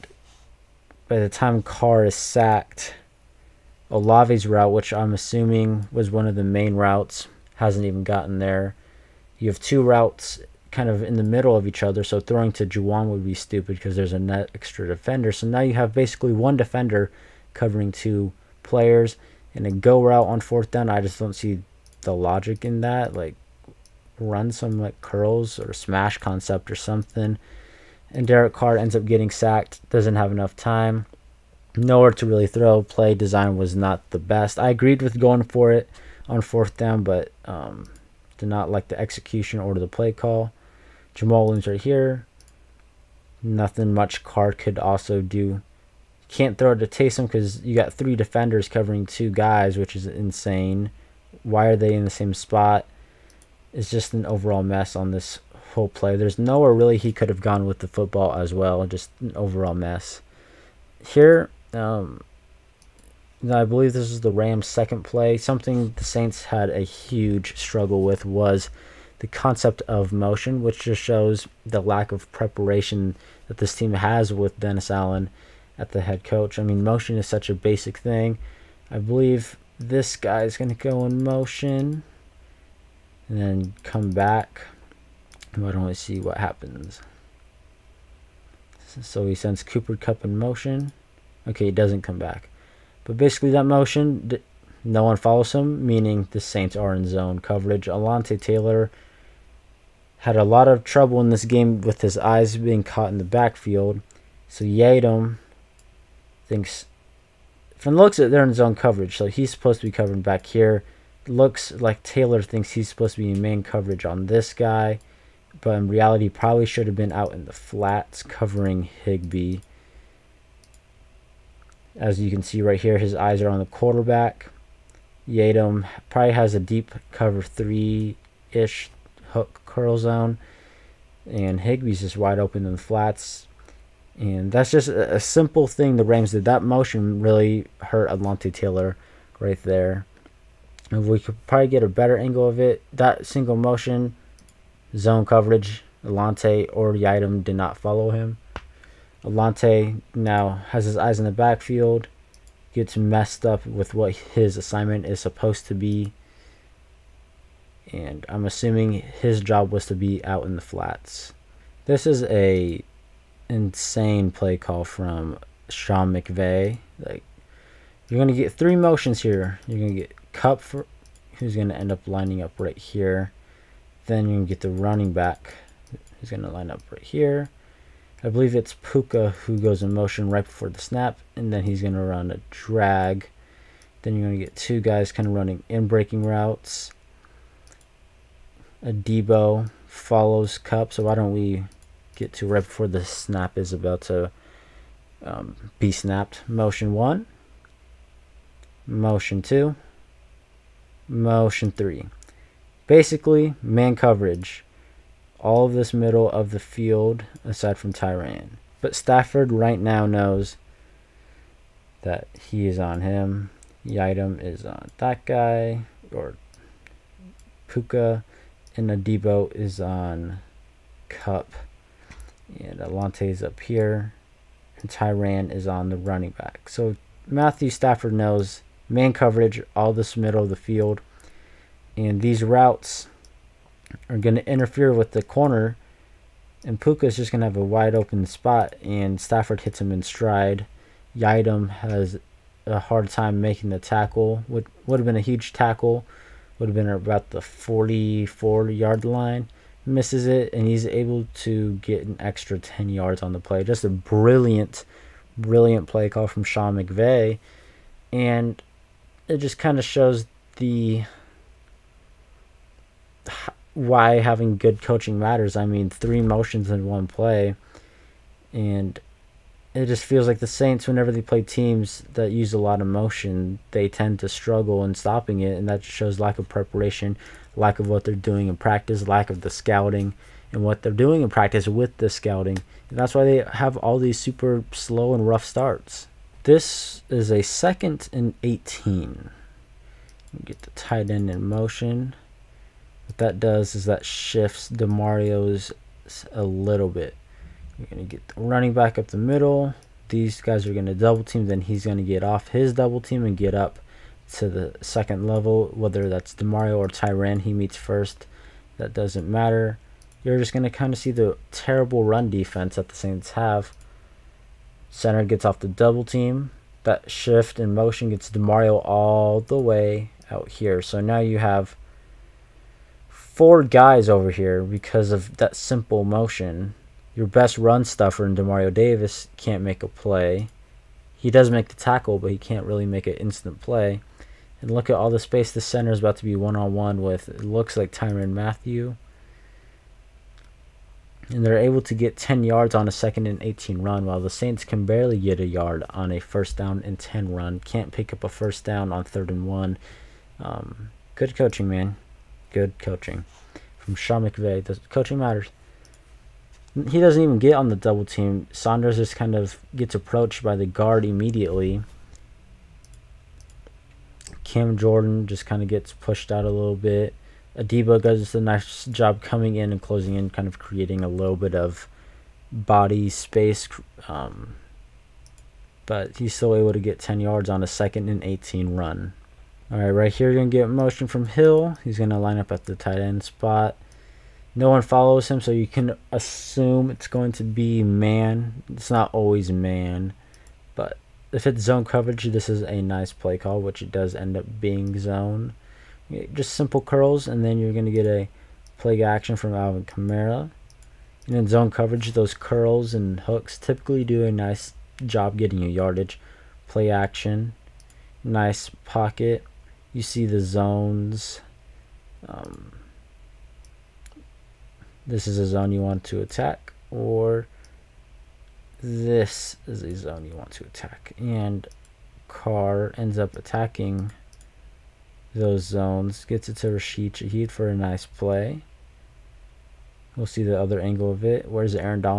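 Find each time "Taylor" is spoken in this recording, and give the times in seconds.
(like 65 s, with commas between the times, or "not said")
98 s, 112 s, 138 s.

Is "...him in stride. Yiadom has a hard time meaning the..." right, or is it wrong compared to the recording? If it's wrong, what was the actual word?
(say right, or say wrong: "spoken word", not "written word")
wrong: "making", not "meaning".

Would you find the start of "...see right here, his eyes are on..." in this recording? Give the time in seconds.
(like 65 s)
122 s.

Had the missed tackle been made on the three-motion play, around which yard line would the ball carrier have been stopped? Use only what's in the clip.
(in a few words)
44.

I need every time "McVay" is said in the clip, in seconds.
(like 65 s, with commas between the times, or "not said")
166 s, 256 s, 354 s.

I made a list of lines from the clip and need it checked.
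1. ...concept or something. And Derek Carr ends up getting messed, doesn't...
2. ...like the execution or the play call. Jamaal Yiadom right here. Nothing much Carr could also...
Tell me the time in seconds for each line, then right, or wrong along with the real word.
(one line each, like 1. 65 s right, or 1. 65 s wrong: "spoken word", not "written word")
1. 26 s wrong: "sacked", not "messed"
2. 38 s wrong: "Williams", not "Yiadom".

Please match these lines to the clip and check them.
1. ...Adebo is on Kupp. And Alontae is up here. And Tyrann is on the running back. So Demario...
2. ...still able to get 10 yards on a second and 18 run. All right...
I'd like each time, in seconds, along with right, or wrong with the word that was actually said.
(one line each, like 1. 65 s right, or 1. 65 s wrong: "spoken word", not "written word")
1. 218 s wrong: "Matthew", not "Demario"
2. 376 s right.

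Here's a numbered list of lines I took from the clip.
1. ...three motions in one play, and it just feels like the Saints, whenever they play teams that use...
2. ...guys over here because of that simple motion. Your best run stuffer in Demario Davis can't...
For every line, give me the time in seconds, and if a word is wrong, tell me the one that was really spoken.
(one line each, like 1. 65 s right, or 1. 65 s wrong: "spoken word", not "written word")
1. 265 s right
2. 323 s right.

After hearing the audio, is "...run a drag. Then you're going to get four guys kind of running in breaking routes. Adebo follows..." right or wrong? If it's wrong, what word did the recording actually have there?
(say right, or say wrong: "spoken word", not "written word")
wrong: "two", not "four".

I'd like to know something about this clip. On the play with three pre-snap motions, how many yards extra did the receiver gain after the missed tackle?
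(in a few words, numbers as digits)
10.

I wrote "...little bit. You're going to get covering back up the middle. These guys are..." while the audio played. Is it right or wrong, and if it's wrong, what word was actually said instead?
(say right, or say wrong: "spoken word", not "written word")
wrong: "running", not "covering".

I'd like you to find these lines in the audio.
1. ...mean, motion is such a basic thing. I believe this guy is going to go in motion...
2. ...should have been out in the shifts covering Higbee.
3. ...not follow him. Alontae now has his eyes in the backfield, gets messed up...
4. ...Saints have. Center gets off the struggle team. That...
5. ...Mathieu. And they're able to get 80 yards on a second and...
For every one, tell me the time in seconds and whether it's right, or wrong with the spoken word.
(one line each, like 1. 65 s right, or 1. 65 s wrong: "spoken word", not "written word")
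1. 76 s right
2. 116 s wrong: "flats", not "shifts"
3. 147 s right
4. 312 s wrong: "double", not "struggle"
5. 338 s wrong: "10", not "80".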